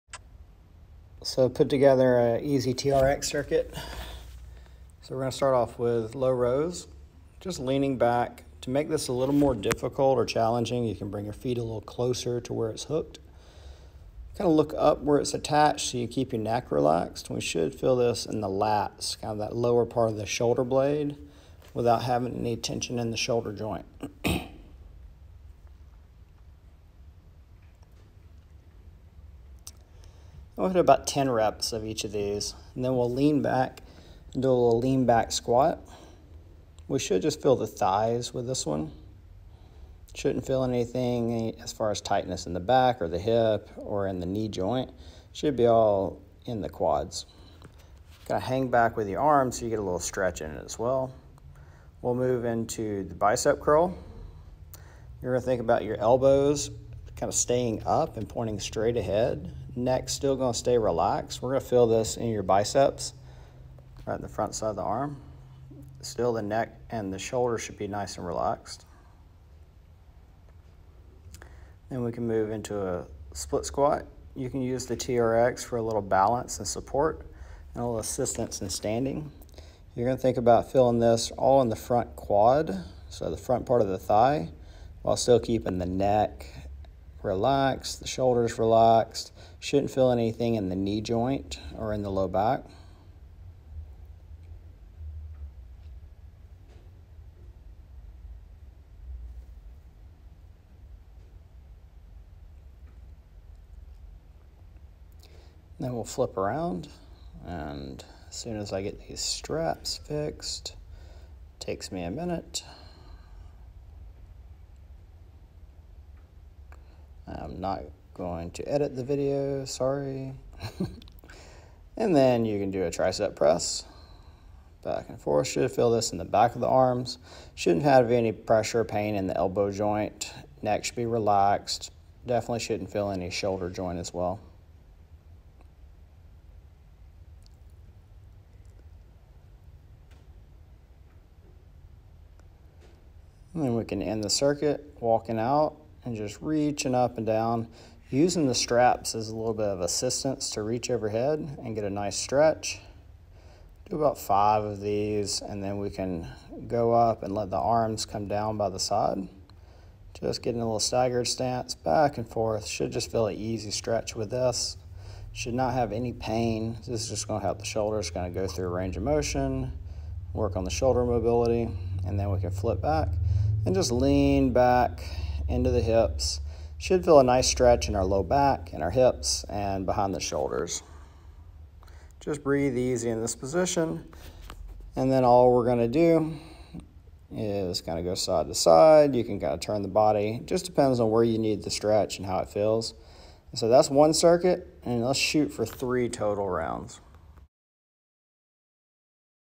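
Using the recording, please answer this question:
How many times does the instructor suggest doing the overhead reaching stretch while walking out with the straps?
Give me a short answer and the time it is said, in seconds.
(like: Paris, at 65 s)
5, at 153 s.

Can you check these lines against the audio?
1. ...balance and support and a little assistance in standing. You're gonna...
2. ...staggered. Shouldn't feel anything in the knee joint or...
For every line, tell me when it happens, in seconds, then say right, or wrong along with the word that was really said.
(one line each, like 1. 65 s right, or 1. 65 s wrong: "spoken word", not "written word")
1. 76 s right
2. 88 s wrong: "relaxed", not "staggered".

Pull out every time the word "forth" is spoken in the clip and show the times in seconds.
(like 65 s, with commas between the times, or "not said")
125 s, 162 s.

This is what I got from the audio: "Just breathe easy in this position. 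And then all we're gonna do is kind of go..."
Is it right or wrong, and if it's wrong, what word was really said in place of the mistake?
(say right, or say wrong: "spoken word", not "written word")
right.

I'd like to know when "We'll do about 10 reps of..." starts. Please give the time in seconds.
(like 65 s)
30 s.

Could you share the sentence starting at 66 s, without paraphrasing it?
Still the neck and the shoulder should be nice and relaxed.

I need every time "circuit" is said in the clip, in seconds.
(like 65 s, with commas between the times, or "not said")
3 s, 144 s, 194 s.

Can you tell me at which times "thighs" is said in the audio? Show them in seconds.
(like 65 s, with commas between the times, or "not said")
37 s, 83 s.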